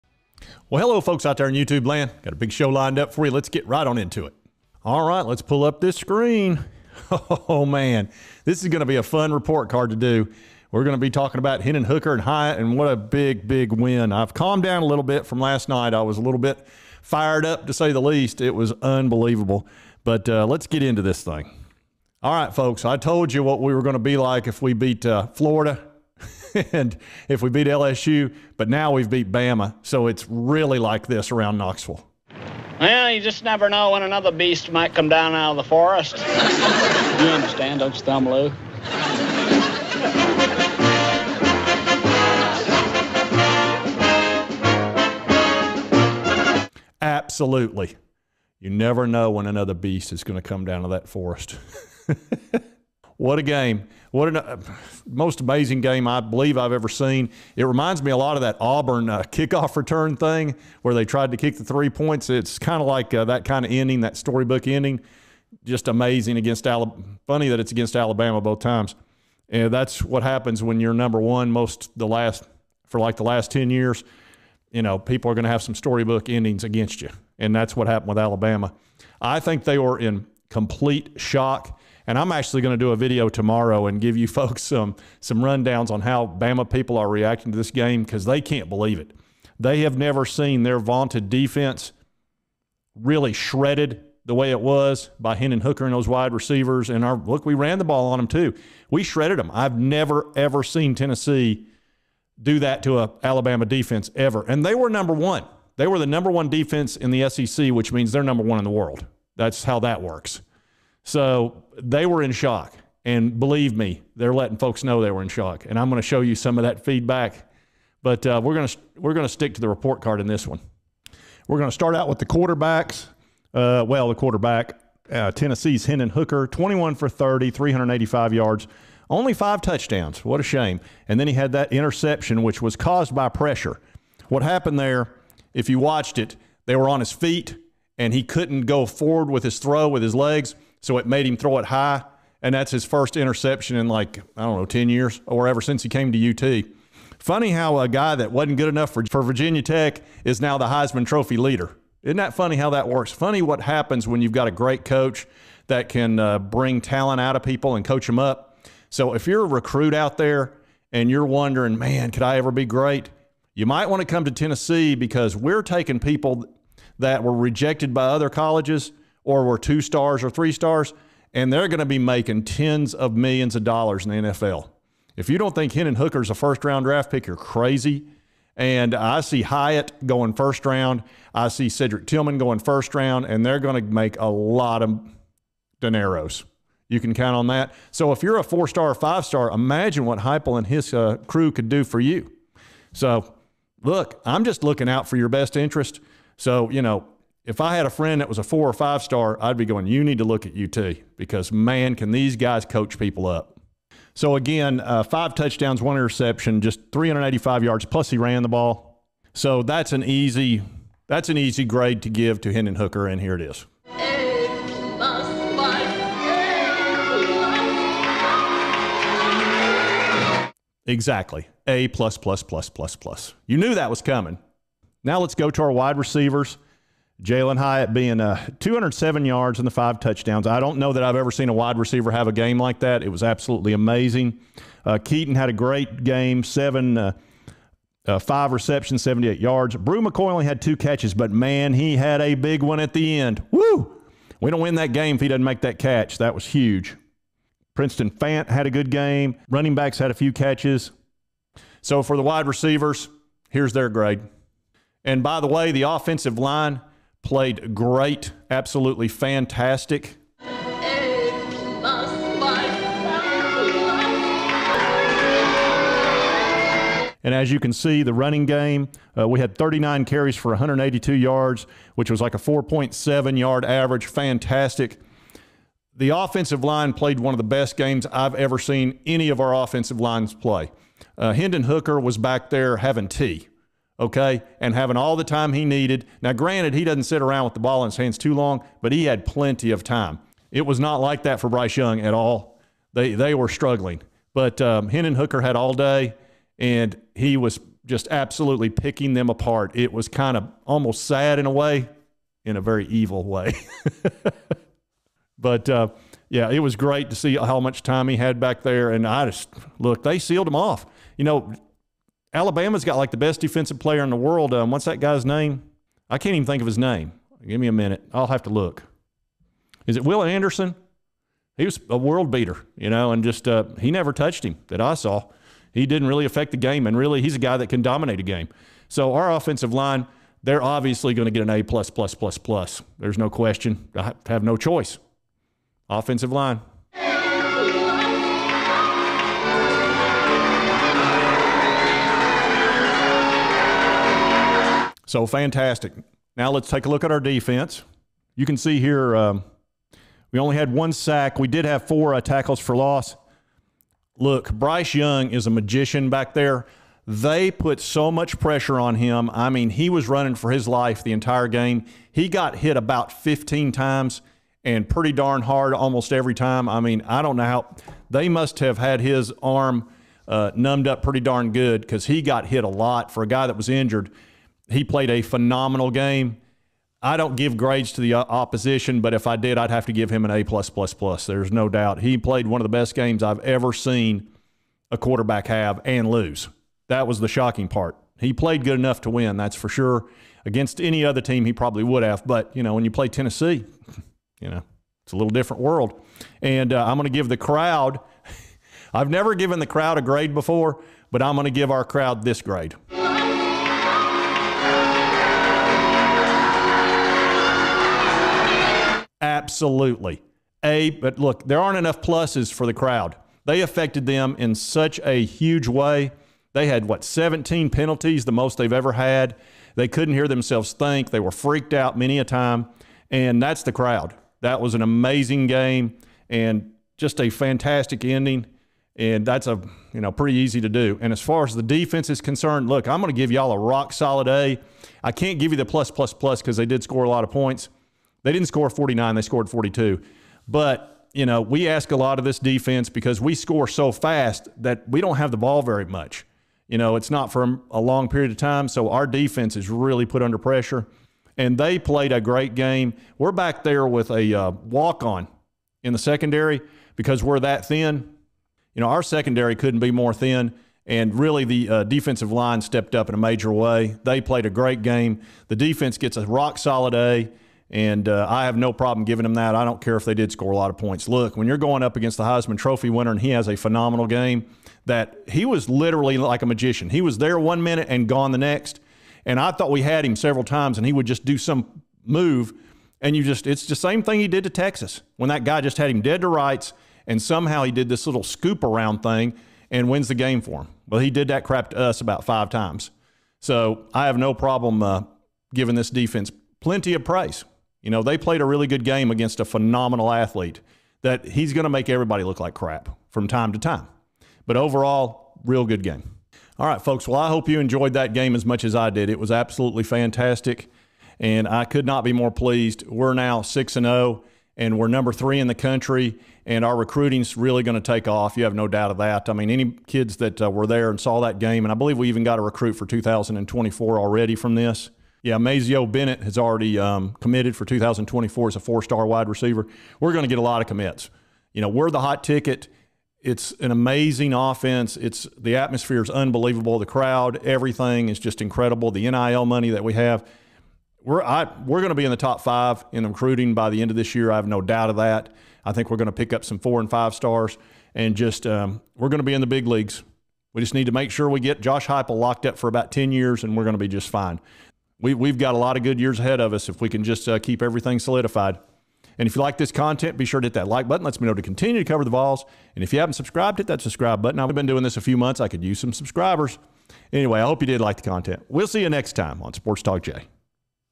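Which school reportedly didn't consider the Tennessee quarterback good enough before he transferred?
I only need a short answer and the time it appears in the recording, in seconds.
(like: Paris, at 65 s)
Virginia Tech, at 149 s.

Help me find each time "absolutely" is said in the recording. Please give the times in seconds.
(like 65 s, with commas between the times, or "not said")
47 s, 233 s, 258 s, 298 s, 409 s, 509 s.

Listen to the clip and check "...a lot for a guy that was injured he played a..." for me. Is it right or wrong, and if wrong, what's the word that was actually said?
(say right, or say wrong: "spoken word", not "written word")
right.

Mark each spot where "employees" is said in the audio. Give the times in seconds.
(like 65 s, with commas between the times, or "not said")
not said.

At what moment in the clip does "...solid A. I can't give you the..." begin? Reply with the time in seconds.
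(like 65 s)
433 s.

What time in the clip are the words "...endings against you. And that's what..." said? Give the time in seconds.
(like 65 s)
76 s.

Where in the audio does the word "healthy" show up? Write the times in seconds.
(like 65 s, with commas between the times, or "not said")
not said.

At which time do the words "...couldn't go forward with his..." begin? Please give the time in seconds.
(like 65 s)
138 s.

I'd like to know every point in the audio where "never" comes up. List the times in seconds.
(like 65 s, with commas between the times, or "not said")
33 s, 48 s, 89 s, 99 s, 323 s, 399 s.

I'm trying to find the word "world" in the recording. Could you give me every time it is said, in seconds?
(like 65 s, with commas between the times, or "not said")
108 s, 314 s, 321 s, 395 s.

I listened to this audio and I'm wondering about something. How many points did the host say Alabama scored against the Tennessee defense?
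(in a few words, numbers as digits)
42.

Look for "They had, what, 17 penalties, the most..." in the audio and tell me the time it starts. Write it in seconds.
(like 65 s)
416 s.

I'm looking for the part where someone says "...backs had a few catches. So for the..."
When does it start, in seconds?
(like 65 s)
249 s.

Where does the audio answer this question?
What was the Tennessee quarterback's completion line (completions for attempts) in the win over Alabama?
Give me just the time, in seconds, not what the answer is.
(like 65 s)
126 s.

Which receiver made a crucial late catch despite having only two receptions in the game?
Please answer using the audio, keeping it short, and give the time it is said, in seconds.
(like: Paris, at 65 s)
Bru McCoy, at 239 s.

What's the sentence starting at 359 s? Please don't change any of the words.
I mean, he was running for his life the entire game.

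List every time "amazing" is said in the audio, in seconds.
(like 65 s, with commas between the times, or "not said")
55 s, 65 s, 233 s, 424 s, 533 s.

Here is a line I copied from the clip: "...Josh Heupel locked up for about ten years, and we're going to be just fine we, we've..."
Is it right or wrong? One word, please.
right.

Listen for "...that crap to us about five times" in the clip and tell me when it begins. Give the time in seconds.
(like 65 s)
491 s.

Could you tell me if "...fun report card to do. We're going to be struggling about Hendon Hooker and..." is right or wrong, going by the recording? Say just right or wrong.
wrong.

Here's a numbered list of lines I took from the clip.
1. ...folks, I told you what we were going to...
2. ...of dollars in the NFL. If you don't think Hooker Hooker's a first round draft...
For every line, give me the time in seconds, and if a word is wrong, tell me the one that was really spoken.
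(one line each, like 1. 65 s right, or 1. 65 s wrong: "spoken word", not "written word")
1. 22 s right
2. 173 s right.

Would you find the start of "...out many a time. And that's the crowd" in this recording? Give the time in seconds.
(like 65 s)
421 s.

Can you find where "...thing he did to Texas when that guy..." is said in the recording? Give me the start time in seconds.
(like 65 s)
484 s.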